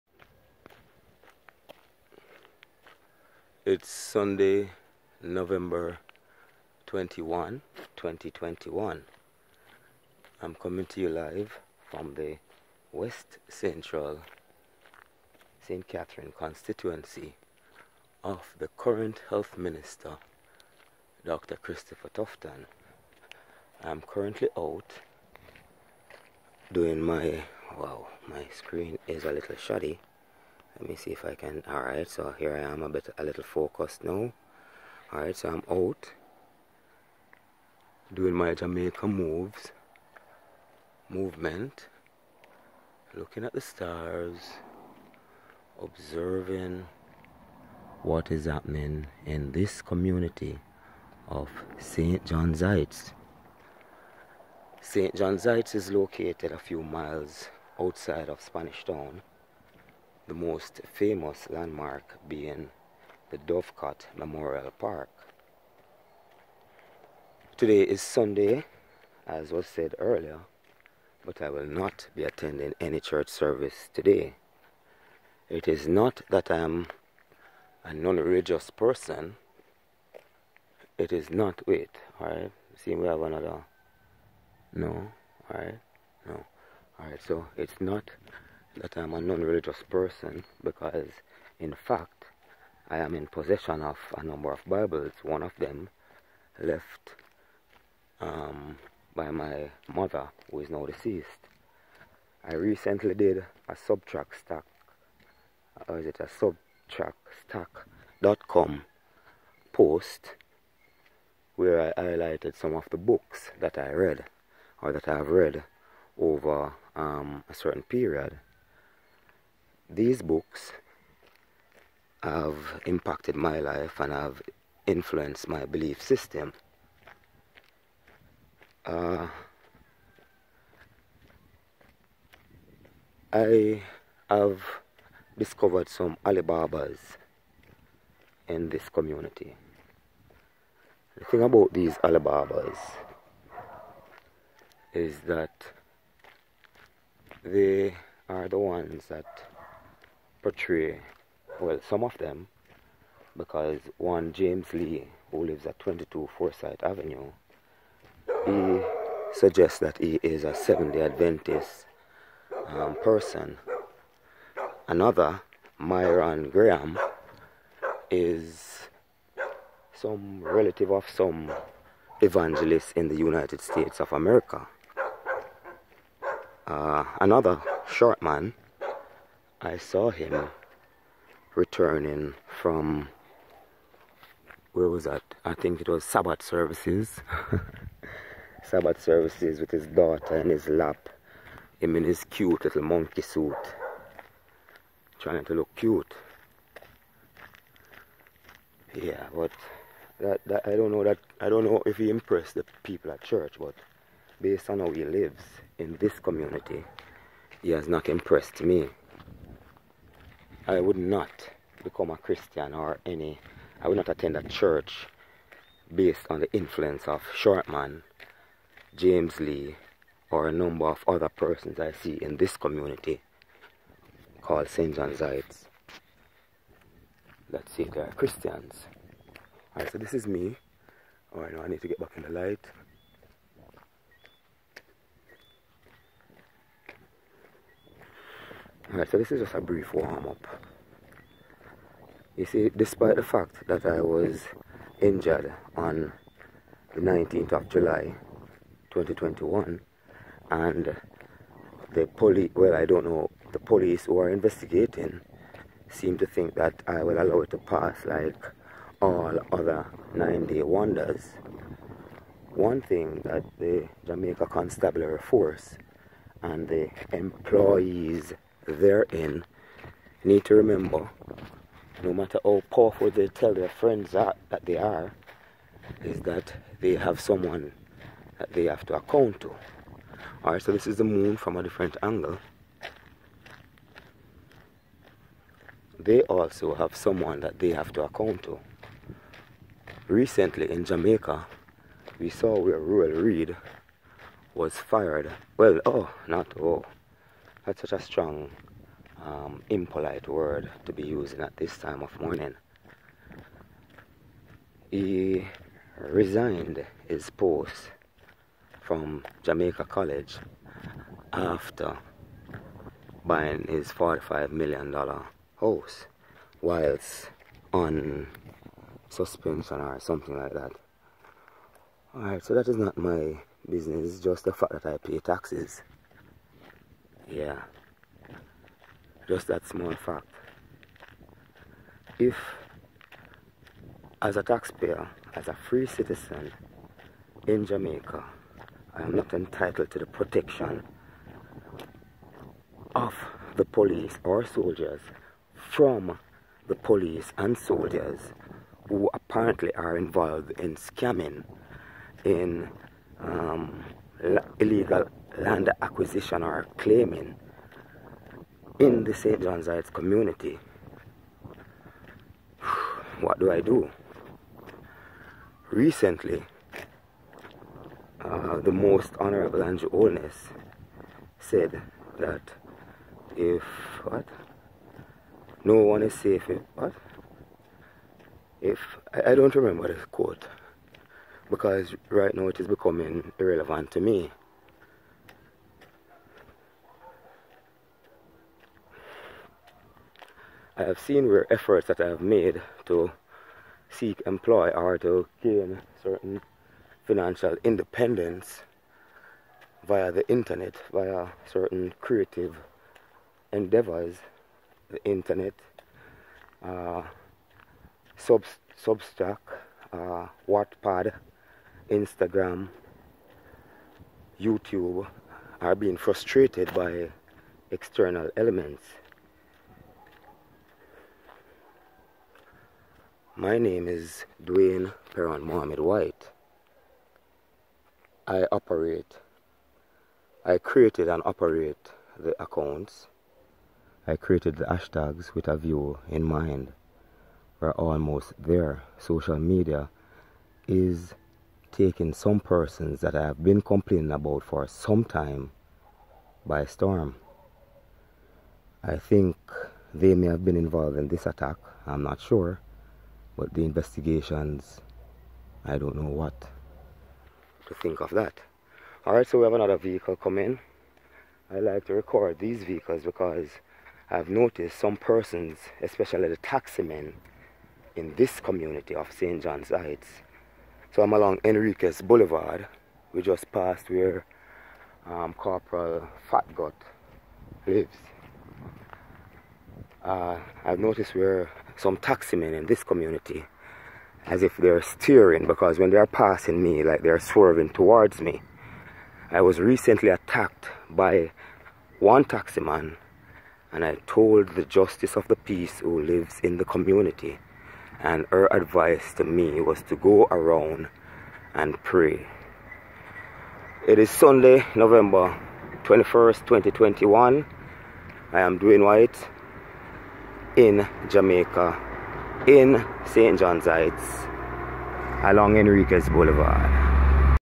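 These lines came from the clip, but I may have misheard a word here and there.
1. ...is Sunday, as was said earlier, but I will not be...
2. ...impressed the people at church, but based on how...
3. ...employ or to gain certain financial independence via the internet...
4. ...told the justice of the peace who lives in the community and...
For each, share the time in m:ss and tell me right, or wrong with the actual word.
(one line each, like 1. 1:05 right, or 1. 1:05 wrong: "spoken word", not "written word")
1. 1:07 right
2. 3:22 right
3. 6:34 right
4. 8:14 right.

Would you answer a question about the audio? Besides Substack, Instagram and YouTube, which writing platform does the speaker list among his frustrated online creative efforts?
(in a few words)
Wattpad.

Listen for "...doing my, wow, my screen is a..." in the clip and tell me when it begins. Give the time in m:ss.
0:26.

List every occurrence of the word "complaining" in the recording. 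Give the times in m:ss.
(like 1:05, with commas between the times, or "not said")
7:23.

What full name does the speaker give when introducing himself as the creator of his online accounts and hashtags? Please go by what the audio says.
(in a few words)
Dwayne Peron Mohammed White.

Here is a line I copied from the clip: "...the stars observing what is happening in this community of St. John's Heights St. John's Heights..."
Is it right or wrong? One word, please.
right.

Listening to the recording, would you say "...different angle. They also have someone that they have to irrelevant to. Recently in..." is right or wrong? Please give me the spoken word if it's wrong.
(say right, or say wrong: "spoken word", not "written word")
wrong: "account", not "irrelevant".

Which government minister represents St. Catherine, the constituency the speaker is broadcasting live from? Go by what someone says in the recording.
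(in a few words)
Dr. Christopher Tufton.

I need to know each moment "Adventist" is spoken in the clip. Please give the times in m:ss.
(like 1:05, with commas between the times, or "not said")
2:41.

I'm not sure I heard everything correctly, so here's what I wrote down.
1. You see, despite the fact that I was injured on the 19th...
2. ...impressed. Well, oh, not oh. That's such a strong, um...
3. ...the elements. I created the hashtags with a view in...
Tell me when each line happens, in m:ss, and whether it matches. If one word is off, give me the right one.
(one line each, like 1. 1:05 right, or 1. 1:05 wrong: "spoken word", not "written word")
1. 4:02 right
2. 4:54 wrong: "fired", not "impressed"
3. 7:12 wrong: "accounts", not "elements".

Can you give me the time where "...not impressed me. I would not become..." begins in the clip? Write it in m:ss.
3:27.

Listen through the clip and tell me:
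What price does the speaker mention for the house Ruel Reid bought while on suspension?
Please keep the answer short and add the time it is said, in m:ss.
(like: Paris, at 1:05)
$45 million, at 5:13.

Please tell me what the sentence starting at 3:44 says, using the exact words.
John's Heights see if they are Christians.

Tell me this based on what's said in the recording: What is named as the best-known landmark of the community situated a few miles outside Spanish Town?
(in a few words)
Dovecot Memorial Park.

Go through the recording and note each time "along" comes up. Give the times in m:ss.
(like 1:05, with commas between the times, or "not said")
7:51, 8:35.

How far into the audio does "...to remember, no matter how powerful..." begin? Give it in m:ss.
4:30.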